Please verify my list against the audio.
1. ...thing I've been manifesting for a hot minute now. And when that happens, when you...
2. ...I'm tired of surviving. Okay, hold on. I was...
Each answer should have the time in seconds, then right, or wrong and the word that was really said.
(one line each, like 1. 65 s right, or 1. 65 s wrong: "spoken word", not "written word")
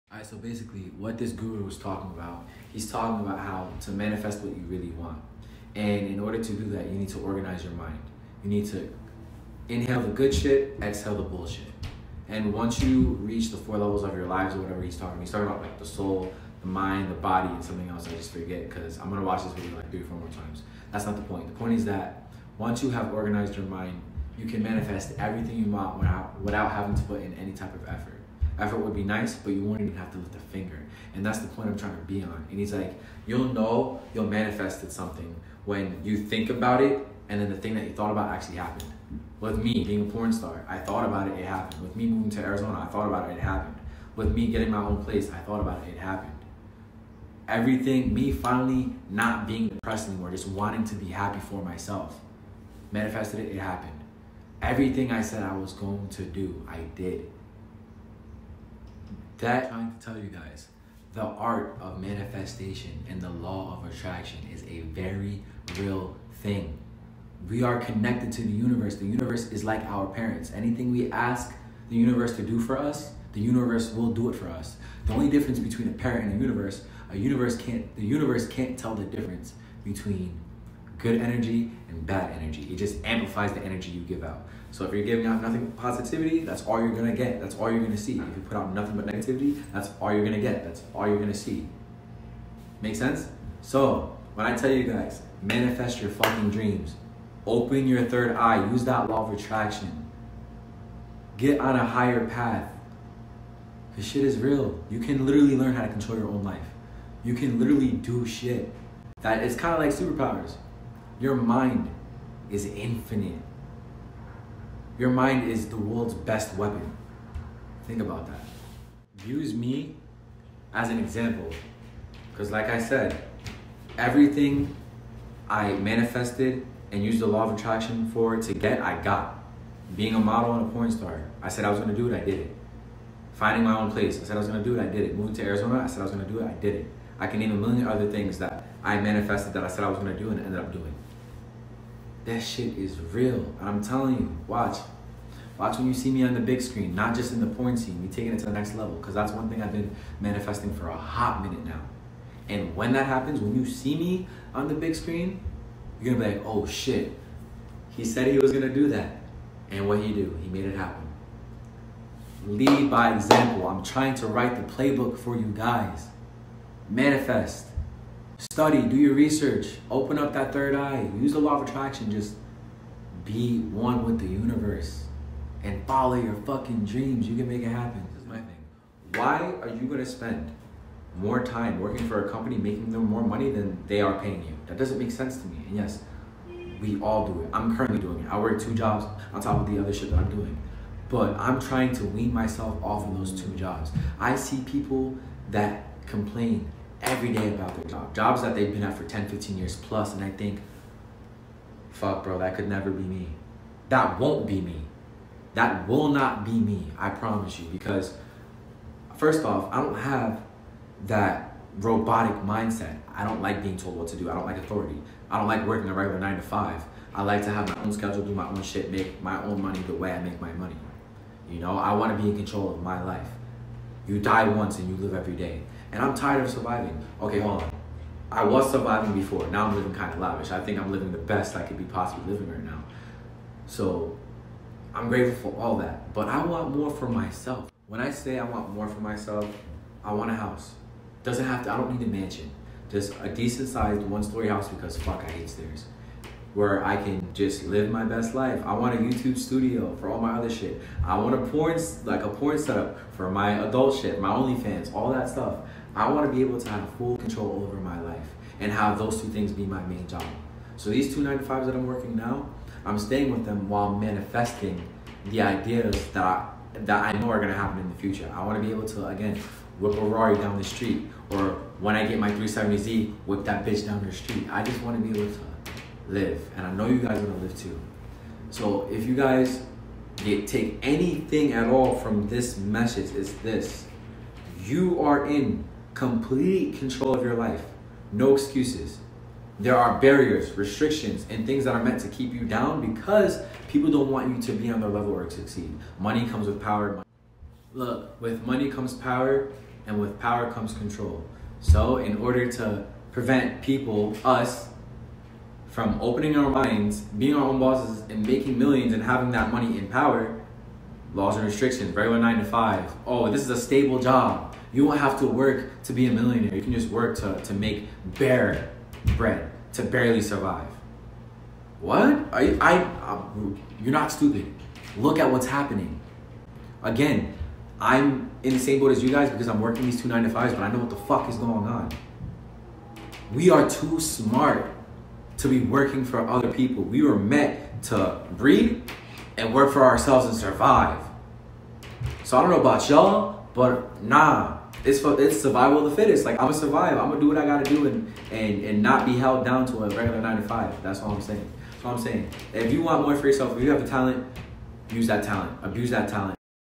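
1. 149 s right
2. 226 s right.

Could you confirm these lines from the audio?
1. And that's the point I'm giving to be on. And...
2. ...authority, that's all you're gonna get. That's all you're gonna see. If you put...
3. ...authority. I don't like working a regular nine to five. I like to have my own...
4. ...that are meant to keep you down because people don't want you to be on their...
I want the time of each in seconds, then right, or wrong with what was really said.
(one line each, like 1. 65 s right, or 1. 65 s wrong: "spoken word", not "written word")
1. 31 s wrong: "trying", not "giving"
2. 85 s wrong: "positivity", not "authority"
3. 214 s right
4. 291 s right.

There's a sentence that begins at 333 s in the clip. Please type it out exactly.
We are too smart to be working for other people.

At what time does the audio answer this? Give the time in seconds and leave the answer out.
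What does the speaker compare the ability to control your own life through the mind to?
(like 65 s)
109 s.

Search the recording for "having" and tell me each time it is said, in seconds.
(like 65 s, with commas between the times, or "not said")
26 s, 309 s.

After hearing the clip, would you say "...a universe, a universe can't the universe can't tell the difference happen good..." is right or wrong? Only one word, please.
wrong.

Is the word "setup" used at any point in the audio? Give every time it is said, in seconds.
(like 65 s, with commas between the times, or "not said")
252 s.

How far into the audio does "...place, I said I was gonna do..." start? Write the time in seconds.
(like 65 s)
133 s.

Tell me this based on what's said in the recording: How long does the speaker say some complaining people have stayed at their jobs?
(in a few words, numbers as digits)
10, 15 years.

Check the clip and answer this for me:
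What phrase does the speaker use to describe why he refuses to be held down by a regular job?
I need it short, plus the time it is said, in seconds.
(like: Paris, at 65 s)
survival of the fittest, at 345 s.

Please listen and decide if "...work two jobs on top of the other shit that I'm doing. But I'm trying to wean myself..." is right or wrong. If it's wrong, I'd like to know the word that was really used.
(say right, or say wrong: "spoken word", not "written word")
right.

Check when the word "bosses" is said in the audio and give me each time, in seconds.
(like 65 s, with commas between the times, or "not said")
307 s.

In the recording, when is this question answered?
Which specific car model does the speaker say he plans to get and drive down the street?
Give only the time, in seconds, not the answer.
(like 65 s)
272 s.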